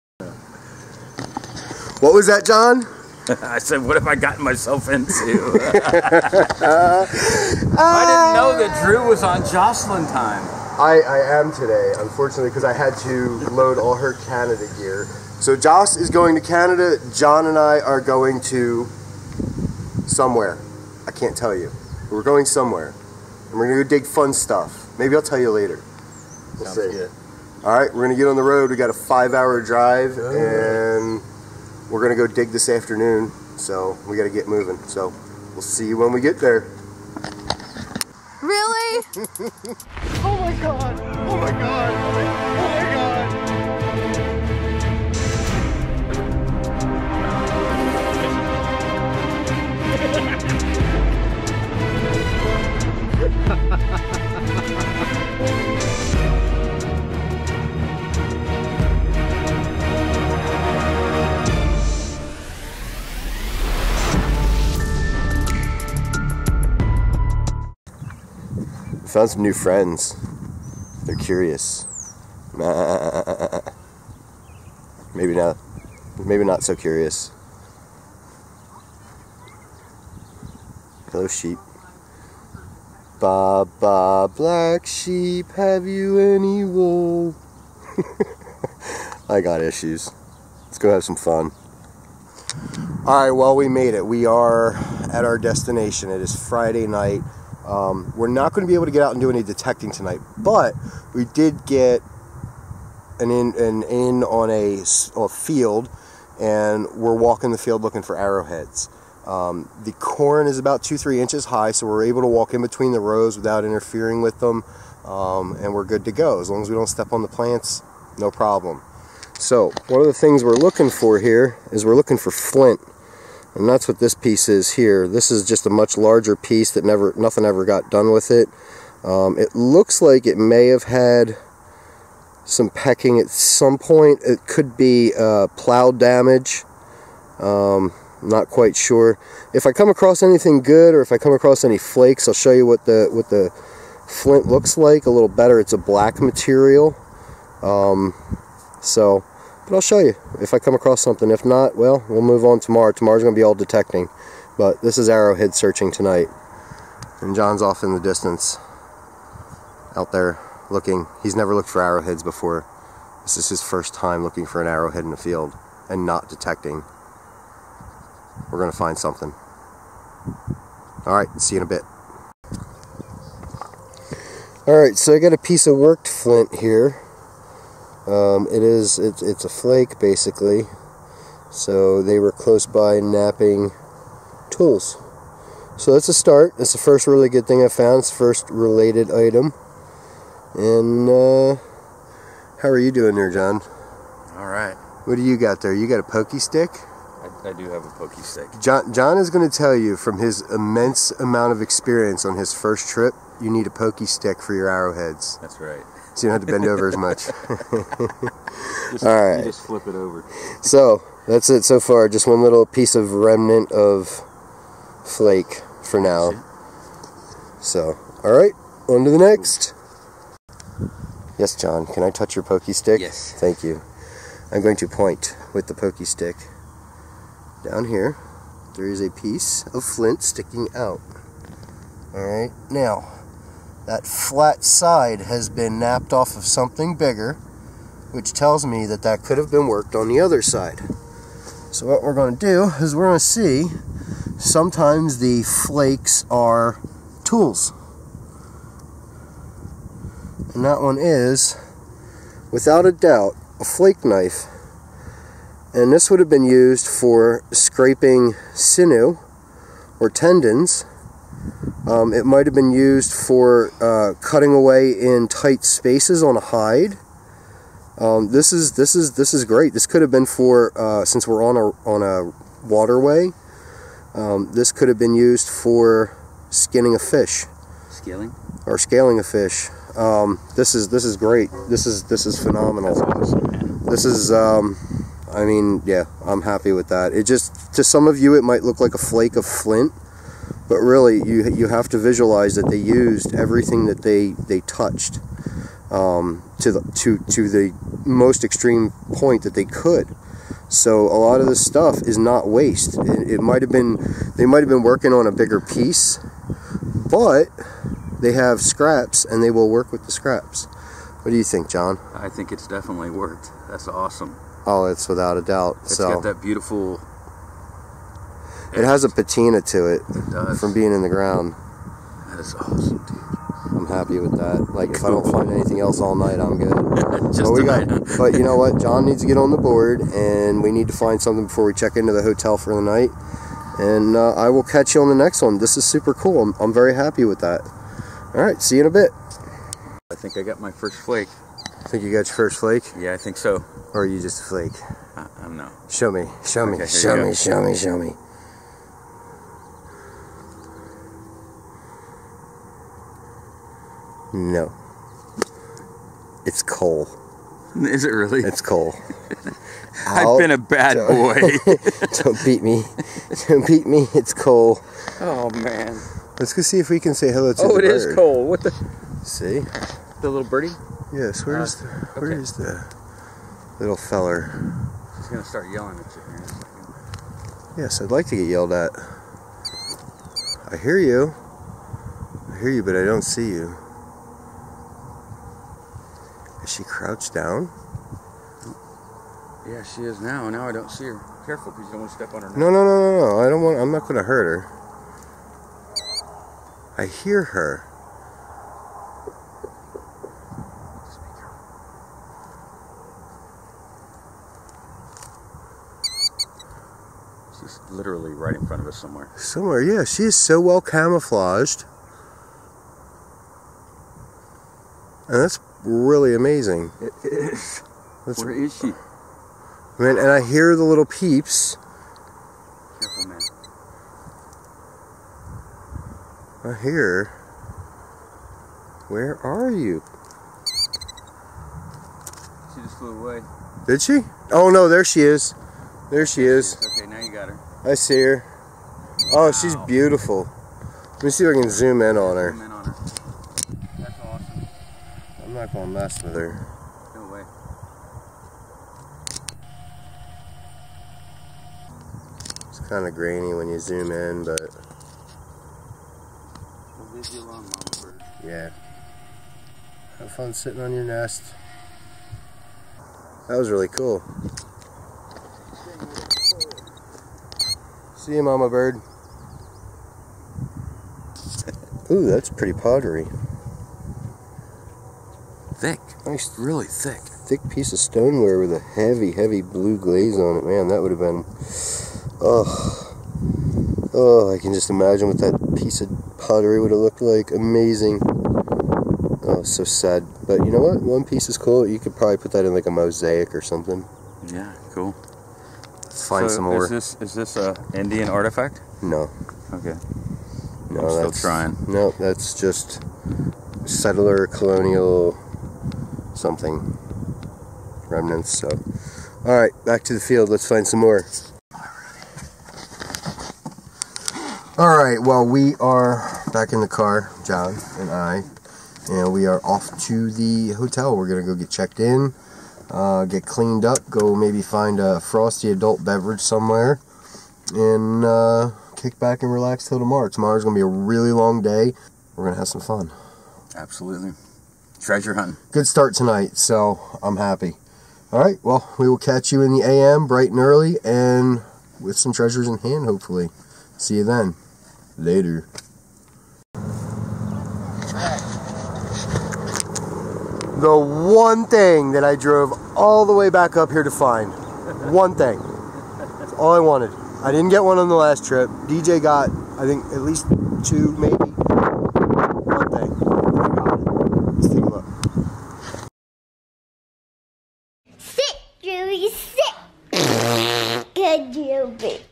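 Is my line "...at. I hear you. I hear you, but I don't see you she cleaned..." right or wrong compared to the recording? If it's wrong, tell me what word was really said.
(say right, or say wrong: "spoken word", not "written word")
wrong: "crouched", not "cleaned".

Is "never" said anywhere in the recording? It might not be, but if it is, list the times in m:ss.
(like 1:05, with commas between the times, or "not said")
2:06, 2:41.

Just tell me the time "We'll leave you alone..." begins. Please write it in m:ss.
7:36.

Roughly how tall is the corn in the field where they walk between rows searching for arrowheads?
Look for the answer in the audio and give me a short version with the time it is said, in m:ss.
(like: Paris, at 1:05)
2 to 3 inches, at 1:50.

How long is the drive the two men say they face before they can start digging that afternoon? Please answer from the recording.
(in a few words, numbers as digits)
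5 hours.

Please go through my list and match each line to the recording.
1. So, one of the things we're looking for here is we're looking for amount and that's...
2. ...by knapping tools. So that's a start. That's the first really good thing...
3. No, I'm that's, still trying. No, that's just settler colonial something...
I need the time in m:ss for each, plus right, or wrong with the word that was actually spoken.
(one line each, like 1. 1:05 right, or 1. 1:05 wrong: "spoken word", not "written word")
1. 1:59 wrong: "flint", not "amount"
2. 3:02 right
3. 8:20 right.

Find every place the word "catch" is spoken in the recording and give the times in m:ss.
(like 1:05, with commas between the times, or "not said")
5:34, 8:59.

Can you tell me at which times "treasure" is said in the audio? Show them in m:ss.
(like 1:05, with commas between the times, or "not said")
8:55, 9:02.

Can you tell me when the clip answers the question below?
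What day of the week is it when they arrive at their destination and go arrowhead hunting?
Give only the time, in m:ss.
1:36.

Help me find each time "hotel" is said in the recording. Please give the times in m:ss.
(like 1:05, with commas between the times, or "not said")
5:32, 8:40.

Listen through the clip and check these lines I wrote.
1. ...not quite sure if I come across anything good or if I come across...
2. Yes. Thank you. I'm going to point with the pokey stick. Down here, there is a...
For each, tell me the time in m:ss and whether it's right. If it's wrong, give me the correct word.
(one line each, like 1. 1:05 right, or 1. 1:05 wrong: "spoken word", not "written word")
1. 2:18 right
2. 3:43 right.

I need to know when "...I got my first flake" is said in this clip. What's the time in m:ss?
5:40.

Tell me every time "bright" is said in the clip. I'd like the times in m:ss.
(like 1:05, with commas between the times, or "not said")
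9:00.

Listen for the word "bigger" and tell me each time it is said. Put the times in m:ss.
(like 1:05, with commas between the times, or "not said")
3:56, 5:05.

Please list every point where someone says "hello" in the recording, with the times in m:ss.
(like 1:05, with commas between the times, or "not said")
1:21, 6:07.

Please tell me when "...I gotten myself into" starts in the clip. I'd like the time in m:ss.
0:04.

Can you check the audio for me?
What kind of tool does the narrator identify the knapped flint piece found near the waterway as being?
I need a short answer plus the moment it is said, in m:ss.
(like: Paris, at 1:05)
Flake knife, at 4:13.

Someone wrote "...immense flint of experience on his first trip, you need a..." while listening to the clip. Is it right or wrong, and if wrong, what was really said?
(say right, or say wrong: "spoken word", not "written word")
wrong: "amount", not "flint".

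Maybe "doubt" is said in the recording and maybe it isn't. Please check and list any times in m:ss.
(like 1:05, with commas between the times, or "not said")
4:12, 5:15.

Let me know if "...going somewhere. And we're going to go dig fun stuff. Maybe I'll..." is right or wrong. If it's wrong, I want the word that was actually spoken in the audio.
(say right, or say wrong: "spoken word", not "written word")
right.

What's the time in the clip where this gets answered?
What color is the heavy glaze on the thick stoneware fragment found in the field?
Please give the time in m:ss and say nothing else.
7:59.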